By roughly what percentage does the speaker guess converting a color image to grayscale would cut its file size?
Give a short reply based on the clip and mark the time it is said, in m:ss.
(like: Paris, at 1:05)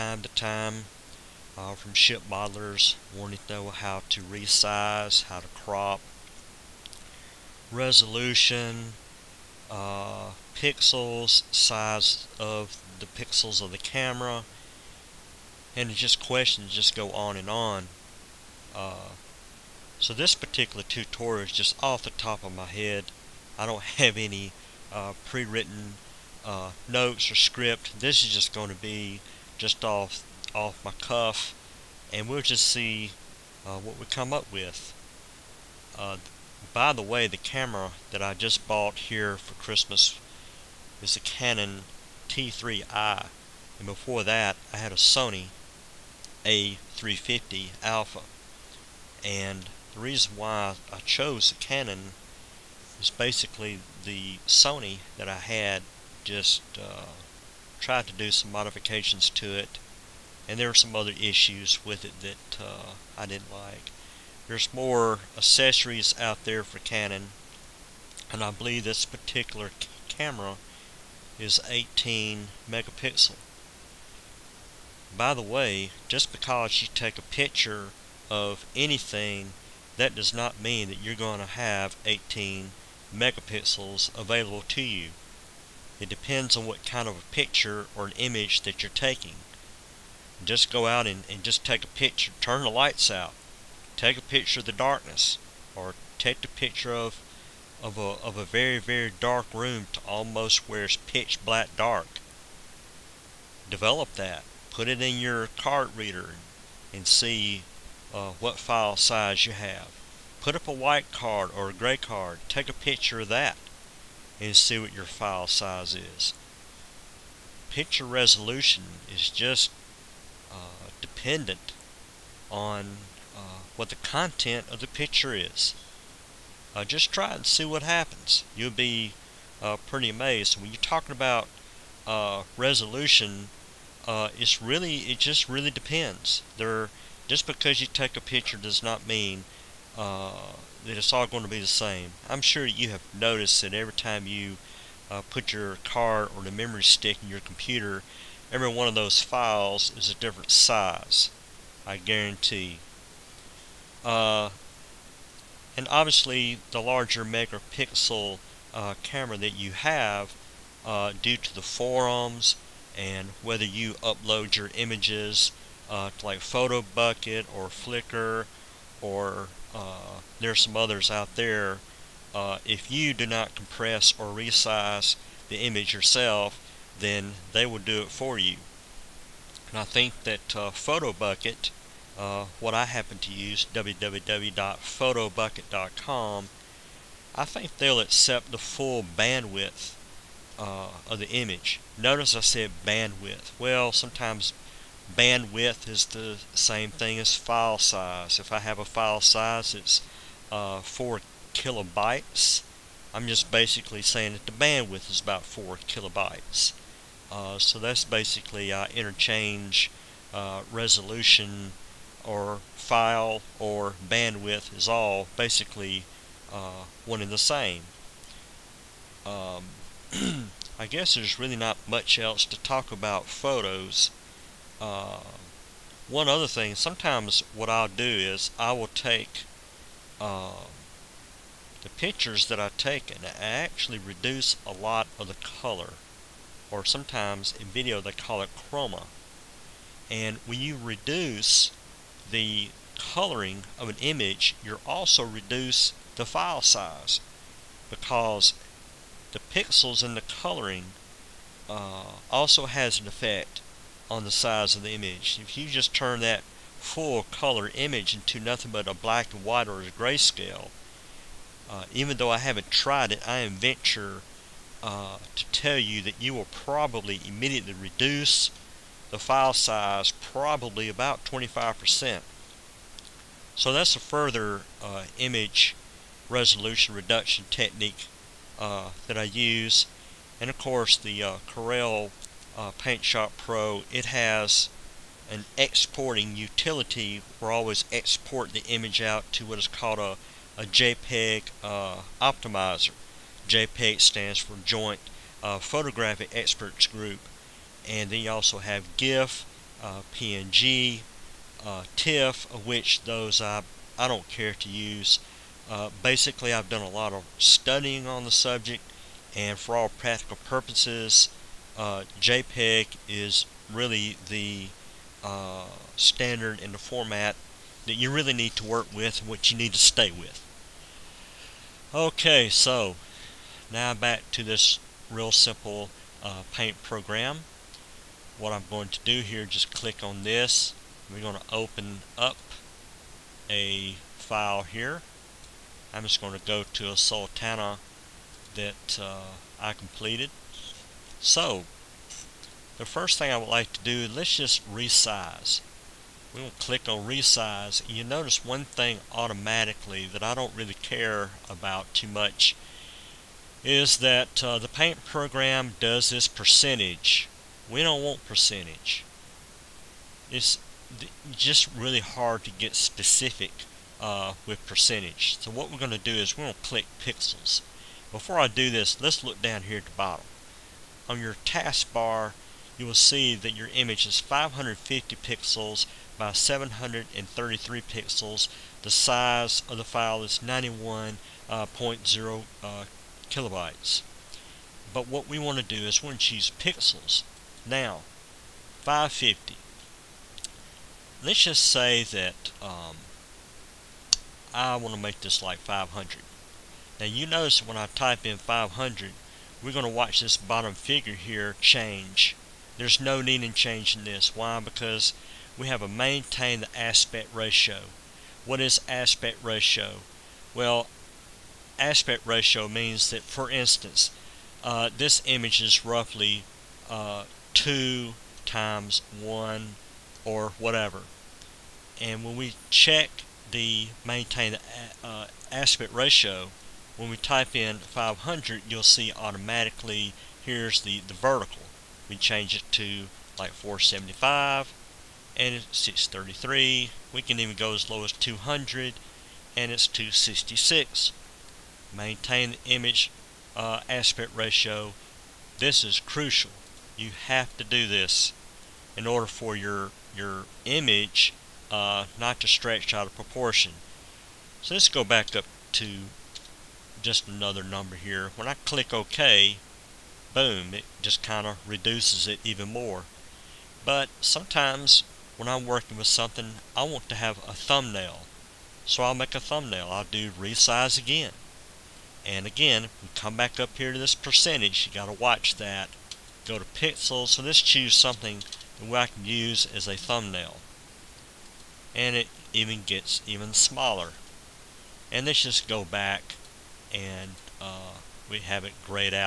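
25%, at 4:31.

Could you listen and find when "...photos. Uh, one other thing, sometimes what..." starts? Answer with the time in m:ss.
3:43.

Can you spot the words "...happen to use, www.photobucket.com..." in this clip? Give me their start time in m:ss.
3:02.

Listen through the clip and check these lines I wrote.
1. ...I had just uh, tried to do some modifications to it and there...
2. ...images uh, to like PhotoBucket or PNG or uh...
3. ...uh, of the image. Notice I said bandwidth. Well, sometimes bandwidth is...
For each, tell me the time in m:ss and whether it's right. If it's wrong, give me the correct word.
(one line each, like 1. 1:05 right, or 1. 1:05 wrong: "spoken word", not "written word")
1. 0:55 right
2. 2:44 wrong: "Flickr", not "PNG"
3. 3:10 right.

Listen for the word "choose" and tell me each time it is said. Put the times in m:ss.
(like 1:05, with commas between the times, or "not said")
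6:26, 7:57.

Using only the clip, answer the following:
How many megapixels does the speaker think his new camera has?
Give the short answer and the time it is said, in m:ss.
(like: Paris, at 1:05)
18, at 1:11.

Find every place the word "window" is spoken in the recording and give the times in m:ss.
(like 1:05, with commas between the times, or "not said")
not said.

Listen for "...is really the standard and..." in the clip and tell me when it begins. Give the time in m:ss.
5:13.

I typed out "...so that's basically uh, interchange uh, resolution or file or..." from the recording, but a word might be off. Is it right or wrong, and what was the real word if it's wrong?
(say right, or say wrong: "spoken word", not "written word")
right.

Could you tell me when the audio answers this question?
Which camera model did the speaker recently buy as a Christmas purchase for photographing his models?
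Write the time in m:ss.
0:41.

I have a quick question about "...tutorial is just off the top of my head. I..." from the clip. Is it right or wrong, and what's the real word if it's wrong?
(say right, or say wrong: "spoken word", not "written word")
right.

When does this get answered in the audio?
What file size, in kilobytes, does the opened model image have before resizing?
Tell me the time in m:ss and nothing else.
6:20.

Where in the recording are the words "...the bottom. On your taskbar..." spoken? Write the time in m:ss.
6:09.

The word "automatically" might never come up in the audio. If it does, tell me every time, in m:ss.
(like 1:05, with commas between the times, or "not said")
5:49, 7:09.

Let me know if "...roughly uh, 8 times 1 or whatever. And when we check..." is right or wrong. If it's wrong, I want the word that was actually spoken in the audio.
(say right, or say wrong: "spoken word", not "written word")
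wrong: "2", not "8".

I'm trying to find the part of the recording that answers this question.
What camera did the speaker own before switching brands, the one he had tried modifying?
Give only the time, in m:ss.
0:44.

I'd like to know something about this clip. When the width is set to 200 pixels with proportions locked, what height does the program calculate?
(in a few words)
266.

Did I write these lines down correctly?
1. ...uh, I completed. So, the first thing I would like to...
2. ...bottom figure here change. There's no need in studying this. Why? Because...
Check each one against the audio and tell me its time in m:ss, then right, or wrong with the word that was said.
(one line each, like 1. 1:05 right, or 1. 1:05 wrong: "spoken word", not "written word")
1. 5:39 right
2. 6:40 wrong: "changing", not "studying".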